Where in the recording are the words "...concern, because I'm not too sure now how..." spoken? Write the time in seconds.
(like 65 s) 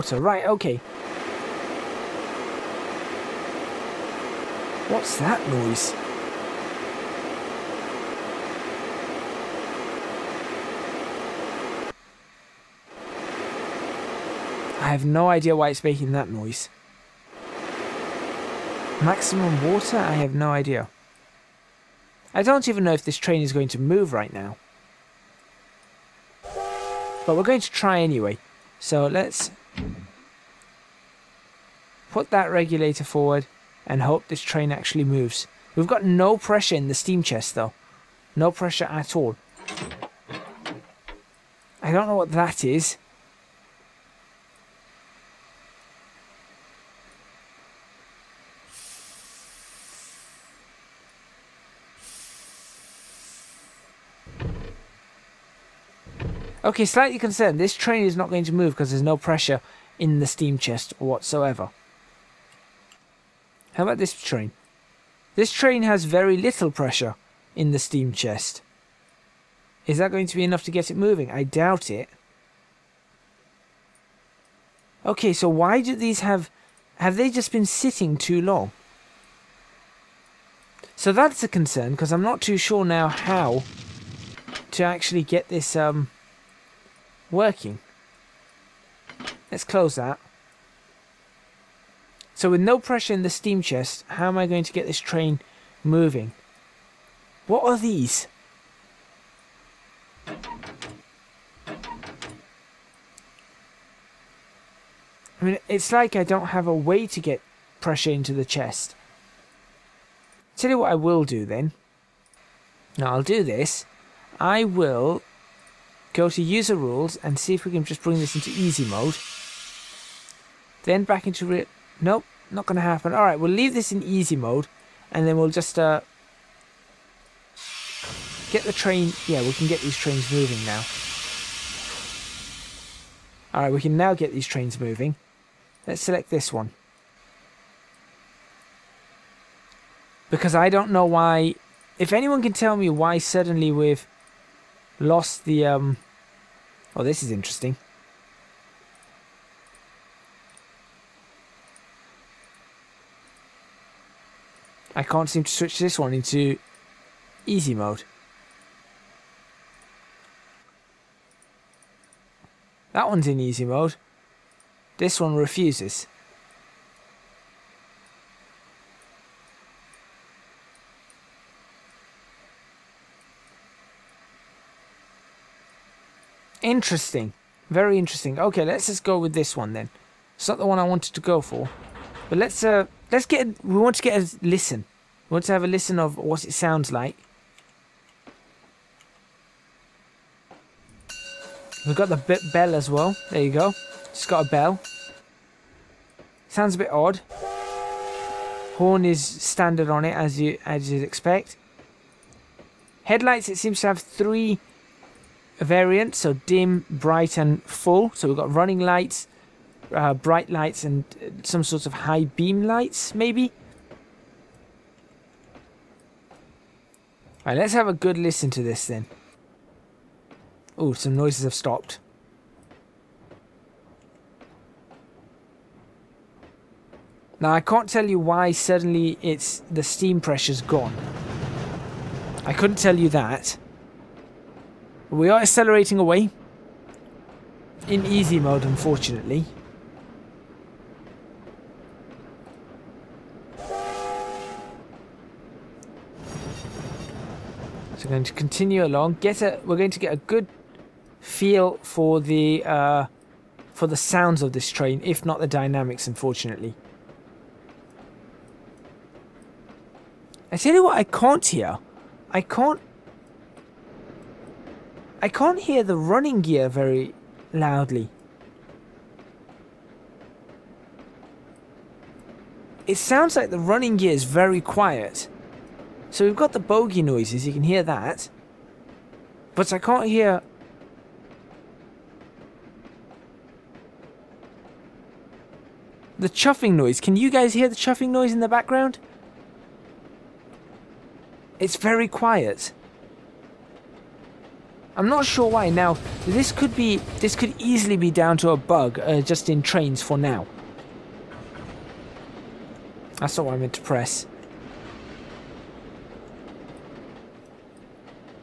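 81 s.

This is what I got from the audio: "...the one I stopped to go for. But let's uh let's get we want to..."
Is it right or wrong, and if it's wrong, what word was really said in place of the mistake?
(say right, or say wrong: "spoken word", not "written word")
wrong: "wanted", not "stopped".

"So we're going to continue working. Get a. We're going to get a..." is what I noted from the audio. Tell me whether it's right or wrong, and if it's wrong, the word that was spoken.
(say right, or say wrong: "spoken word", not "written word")
wrong: "along", not "working".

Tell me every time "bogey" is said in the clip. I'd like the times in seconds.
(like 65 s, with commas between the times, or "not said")
276 s.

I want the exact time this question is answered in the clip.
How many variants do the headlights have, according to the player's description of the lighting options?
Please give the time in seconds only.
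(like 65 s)
203 s.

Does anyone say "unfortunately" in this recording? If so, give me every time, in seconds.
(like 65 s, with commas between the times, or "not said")
238 s, 256 s.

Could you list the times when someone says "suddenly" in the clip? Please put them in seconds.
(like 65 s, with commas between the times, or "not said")
143 s, 228 s.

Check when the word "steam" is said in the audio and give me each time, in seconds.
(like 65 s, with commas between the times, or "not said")
36 s, 60 s, 67 s, 93 s, 229 s.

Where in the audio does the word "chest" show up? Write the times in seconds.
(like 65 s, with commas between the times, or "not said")
37 s, 60 s, 68 s, 93 s, 108 s.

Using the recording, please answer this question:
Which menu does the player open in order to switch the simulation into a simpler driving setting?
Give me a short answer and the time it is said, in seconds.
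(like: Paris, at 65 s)
User rules, at 116 s.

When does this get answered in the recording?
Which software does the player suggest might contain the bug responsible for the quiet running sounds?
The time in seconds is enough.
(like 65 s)
299 s.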